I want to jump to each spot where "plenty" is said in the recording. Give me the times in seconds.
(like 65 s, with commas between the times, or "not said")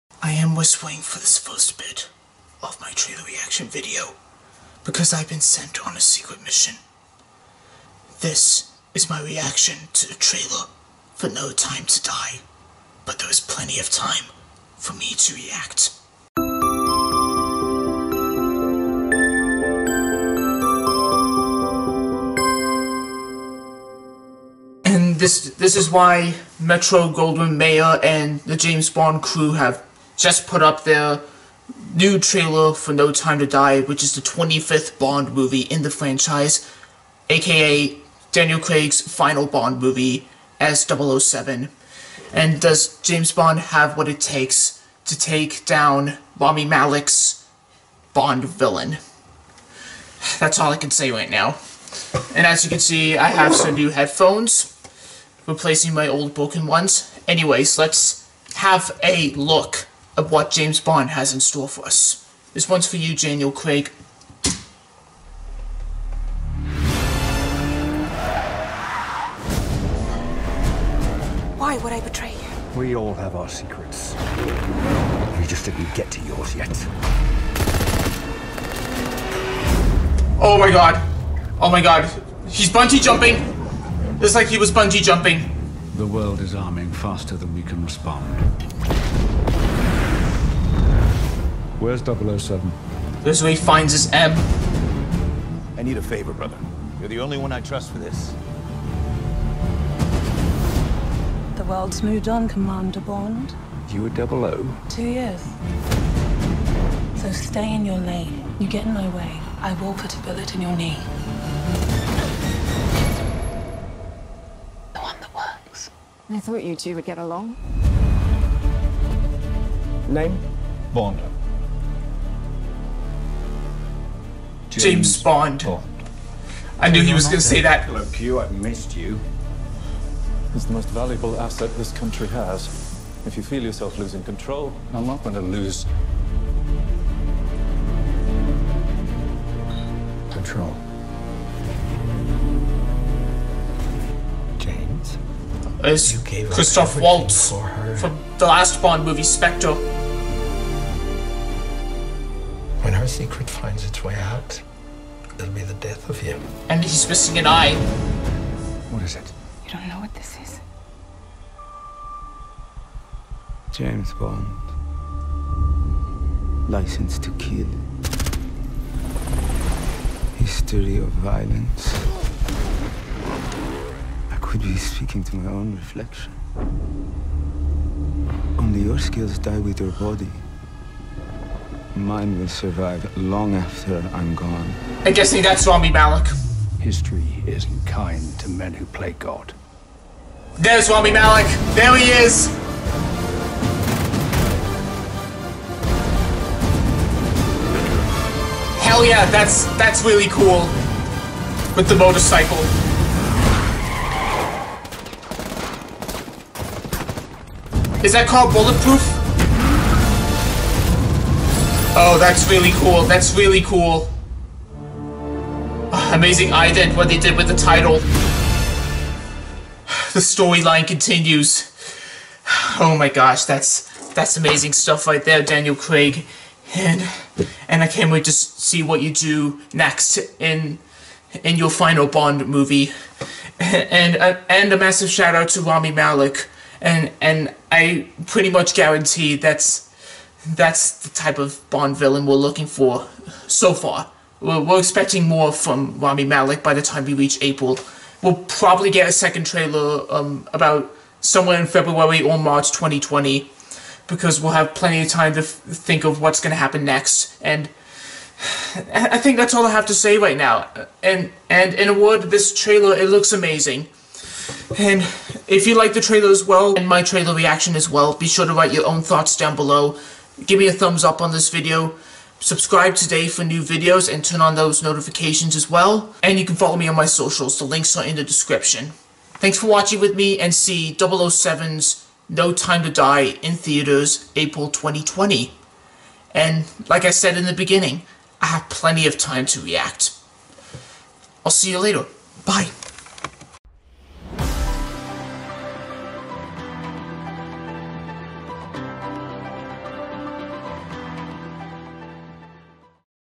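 13 s, 254 s, 288 s.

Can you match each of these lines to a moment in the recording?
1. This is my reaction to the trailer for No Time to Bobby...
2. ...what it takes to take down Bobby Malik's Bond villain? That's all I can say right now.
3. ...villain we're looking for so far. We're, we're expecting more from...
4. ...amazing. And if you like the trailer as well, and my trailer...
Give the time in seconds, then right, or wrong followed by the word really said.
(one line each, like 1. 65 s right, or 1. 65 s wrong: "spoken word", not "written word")
1. 8 s wrong: "Die", not "Bobby"
2. 43 s right
3. 241 s right
4. 263 s right.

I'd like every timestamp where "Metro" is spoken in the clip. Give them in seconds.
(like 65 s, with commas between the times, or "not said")
26 s.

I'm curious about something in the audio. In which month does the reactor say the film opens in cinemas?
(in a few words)
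April 2020.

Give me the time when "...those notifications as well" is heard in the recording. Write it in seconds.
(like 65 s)
274 s.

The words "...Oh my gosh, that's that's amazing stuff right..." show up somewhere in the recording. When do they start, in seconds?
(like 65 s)
222 s.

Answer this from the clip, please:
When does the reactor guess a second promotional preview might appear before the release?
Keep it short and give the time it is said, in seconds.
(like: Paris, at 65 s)
February or March 2020, at 251 s.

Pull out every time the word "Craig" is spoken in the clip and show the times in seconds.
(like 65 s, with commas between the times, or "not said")
38 s, 63 s, 225 s.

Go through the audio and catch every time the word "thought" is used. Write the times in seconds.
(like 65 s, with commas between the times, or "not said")
116 s, 269 s.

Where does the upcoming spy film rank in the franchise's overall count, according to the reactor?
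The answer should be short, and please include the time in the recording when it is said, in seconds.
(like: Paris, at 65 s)
25th, at 34 s.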